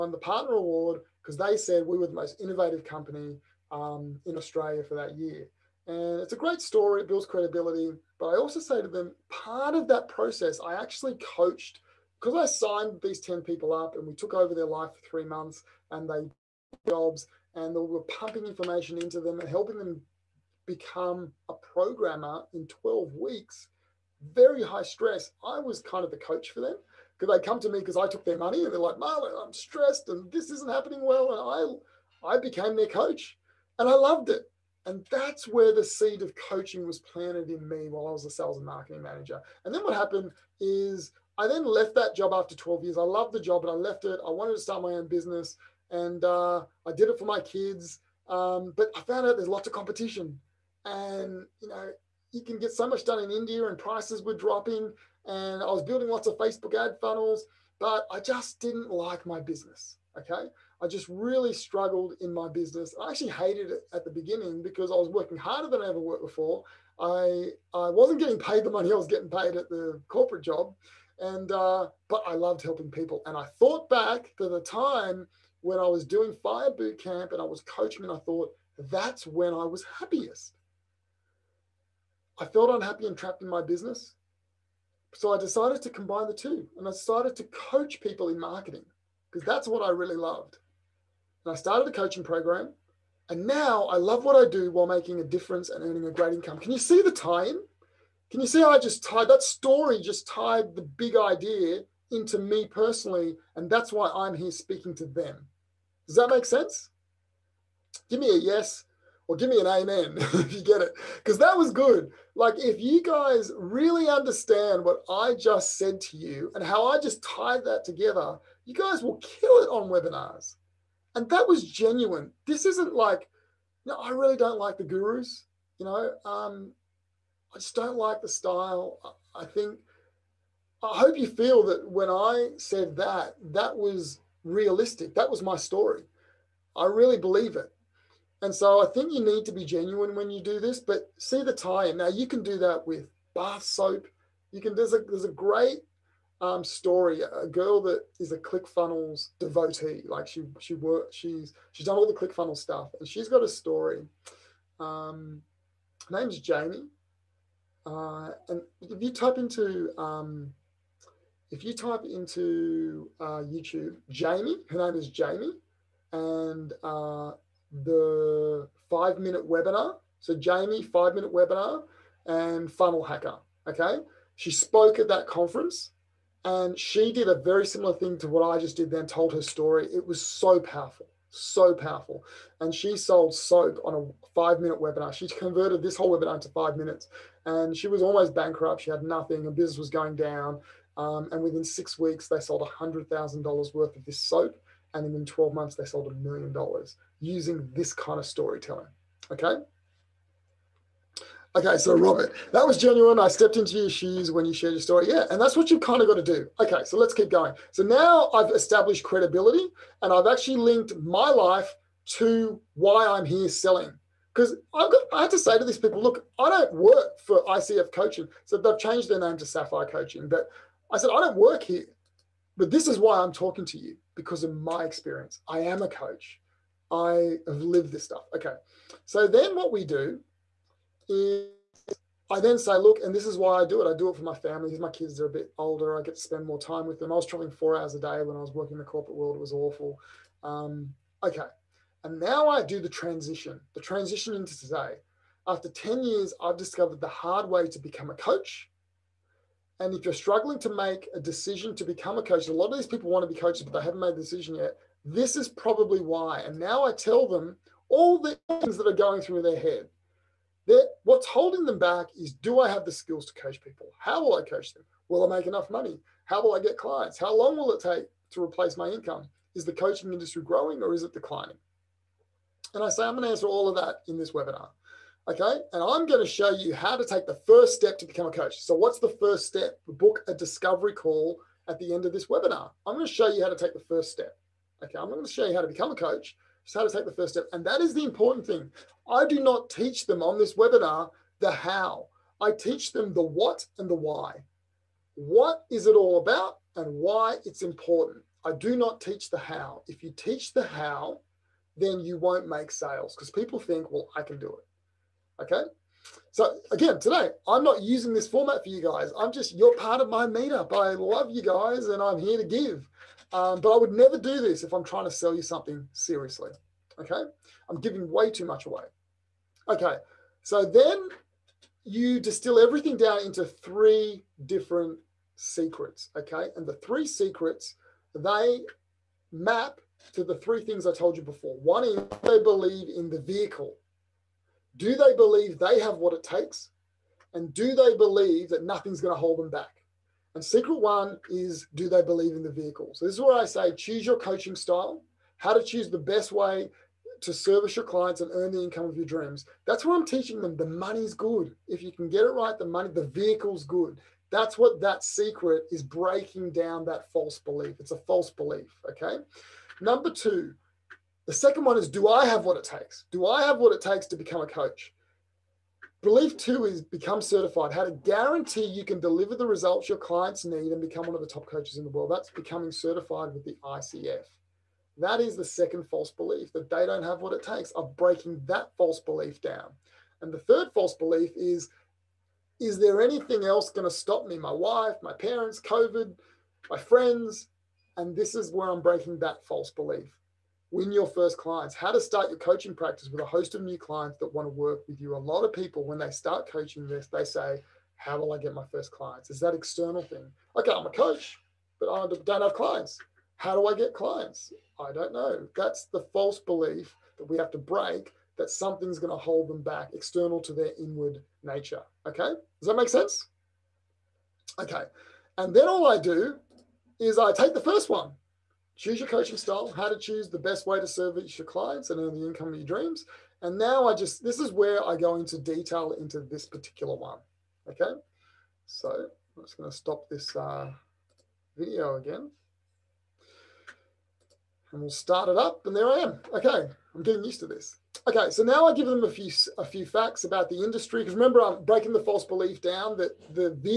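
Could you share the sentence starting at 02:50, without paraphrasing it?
So Jamie, five minute webinar, and funnel hacker.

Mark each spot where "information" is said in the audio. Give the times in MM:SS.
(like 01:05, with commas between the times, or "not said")
00:18.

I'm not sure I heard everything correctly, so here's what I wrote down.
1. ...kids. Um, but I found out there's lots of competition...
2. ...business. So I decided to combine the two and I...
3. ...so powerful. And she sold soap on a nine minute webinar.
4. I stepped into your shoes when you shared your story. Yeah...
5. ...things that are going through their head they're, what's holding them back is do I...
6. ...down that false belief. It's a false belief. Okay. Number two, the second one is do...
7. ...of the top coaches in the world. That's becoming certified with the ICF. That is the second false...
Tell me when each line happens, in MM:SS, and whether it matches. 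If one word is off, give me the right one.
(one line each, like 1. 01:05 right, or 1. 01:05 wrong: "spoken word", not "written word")
1. 00:47 right
2. 01:23 right
3. 03:01 wrong: "five", not "nine"
4. 03:23 right
5. 04:18 right
6. 05:56 right
7. 06:11 right.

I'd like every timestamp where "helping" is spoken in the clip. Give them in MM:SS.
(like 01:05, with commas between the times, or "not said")
00:19, 01:12.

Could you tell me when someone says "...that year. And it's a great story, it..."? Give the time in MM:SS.
00:04.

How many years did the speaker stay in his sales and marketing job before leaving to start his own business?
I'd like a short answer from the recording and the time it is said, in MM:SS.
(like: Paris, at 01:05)
12 years, at 00:42.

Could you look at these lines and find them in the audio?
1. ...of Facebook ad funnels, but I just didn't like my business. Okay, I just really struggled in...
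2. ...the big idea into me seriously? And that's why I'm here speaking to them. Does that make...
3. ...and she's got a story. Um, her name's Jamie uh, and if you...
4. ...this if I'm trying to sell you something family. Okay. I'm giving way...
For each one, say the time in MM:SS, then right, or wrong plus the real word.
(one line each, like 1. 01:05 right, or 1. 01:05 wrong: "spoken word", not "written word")
1. 00:56 right
2. 01:40 wrong: "personally", not "seriously"
3. 02:32 right
4. 05:14 wrong: "seriously", not "family".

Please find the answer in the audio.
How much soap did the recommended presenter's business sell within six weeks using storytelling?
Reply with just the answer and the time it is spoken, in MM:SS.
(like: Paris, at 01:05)
$100,000, at 03:12.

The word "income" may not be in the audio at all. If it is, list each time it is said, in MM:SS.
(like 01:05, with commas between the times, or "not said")
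01:36, 04:28, 05:48, 07:02.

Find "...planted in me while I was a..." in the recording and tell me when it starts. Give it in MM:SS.
00:37.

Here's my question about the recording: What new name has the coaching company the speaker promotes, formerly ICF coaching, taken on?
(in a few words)
Sapphire Coaching.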